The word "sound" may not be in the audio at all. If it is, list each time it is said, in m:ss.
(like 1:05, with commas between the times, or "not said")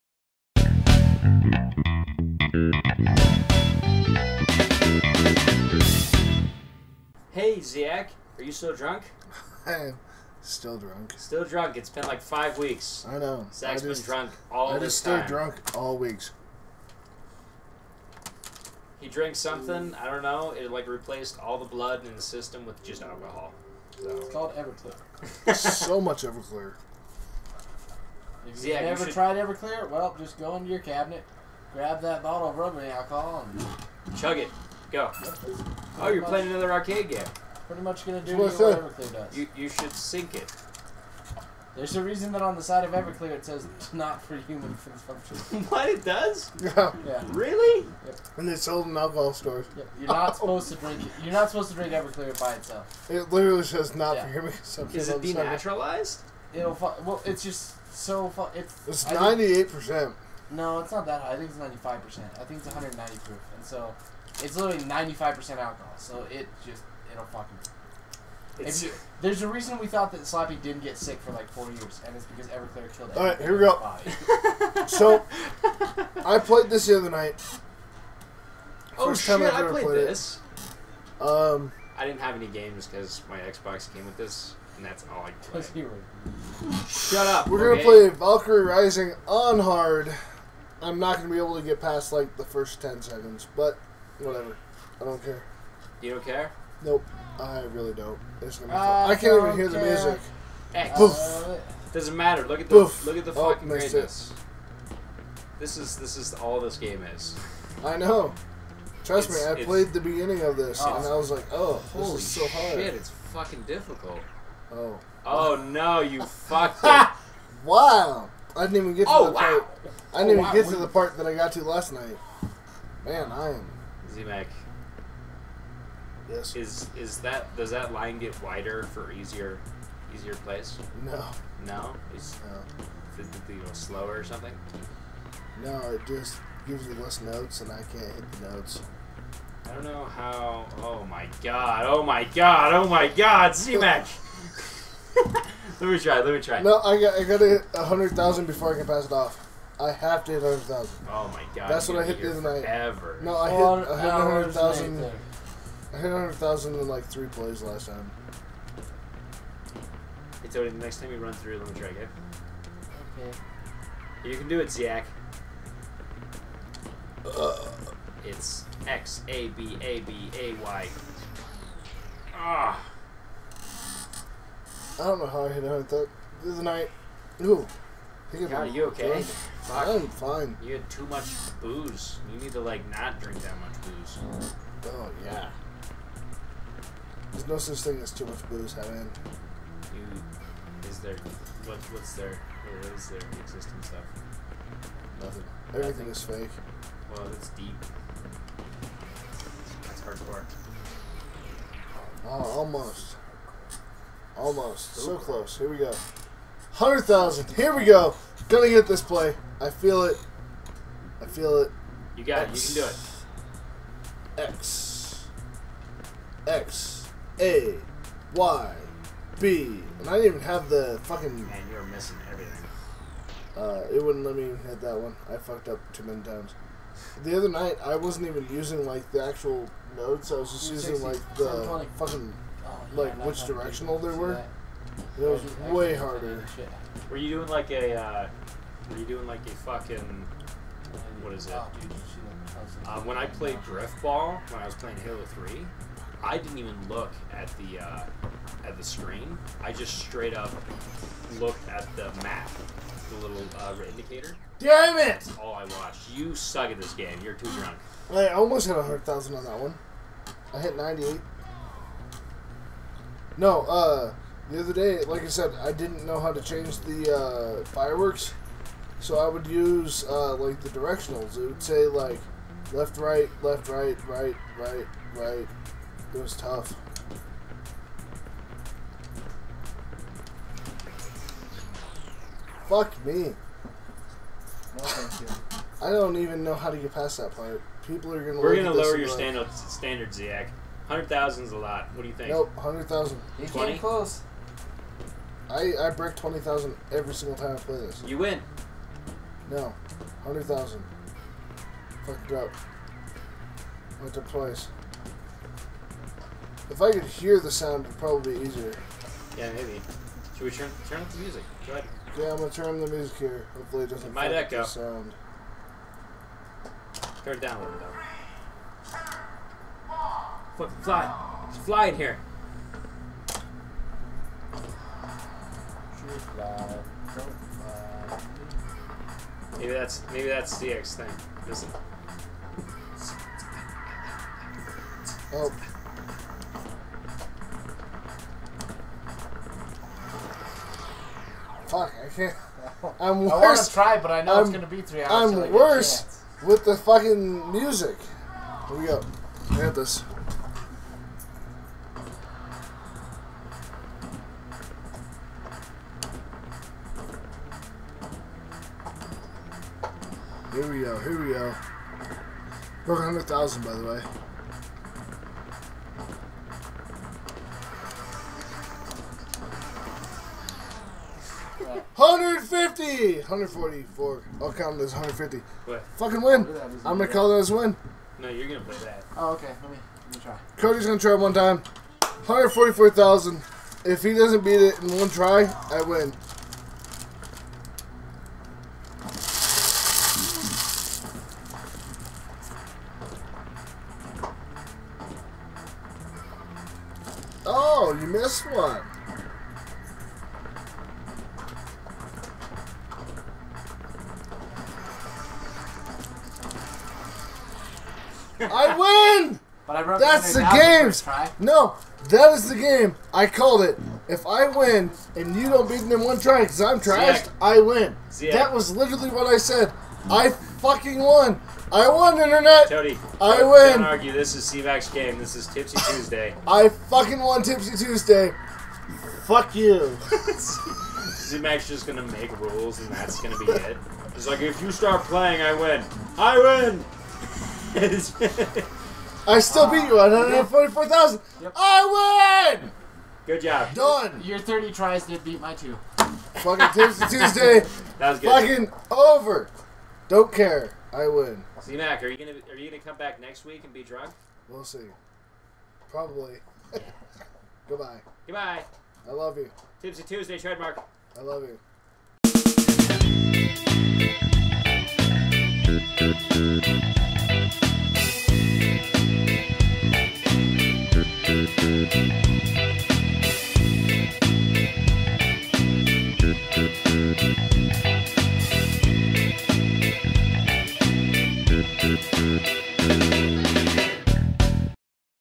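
5:07, 5:14.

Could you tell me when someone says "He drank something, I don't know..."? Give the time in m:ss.
0:18.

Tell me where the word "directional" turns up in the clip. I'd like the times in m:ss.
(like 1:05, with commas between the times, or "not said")
3:53, 4:30.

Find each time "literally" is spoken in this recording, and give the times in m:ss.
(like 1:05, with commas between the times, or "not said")
0:53, 1:04, 6:58.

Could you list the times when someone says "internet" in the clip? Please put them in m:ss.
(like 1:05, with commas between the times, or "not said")
7:02.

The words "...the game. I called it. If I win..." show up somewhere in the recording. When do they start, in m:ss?
6:52.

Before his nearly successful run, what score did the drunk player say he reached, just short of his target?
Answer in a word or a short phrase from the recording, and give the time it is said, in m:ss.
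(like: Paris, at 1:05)
98, at 4:20.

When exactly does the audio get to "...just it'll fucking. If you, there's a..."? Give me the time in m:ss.
1:06.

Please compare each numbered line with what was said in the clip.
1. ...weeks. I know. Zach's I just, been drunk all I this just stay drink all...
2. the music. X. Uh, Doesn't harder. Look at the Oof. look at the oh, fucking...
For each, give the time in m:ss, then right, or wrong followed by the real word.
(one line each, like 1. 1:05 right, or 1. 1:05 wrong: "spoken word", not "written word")
1. 0:12 wrong: "drunk", not "drink"
2. 1:39 wrong: "matter", not "harder".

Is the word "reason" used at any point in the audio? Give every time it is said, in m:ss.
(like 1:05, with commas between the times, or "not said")
0:42, 1:09.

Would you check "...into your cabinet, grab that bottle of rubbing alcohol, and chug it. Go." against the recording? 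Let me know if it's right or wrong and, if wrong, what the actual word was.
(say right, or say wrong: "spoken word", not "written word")
right.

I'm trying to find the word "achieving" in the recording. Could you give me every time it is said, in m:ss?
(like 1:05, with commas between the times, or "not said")
not said.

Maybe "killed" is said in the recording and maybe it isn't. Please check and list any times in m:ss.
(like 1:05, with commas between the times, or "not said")
1:12.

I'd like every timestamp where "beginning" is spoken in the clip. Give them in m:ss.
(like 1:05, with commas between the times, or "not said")
1:50.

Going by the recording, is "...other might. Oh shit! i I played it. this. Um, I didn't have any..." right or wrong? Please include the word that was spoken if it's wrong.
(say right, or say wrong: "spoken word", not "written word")
wrong: "night", not "might".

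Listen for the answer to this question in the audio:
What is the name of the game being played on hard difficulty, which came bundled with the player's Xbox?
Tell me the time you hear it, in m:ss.
1:28.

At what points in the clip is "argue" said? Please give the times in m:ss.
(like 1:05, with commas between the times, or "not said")
7:03.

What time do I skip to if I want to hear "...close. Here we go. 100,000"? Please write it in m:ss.
3:25.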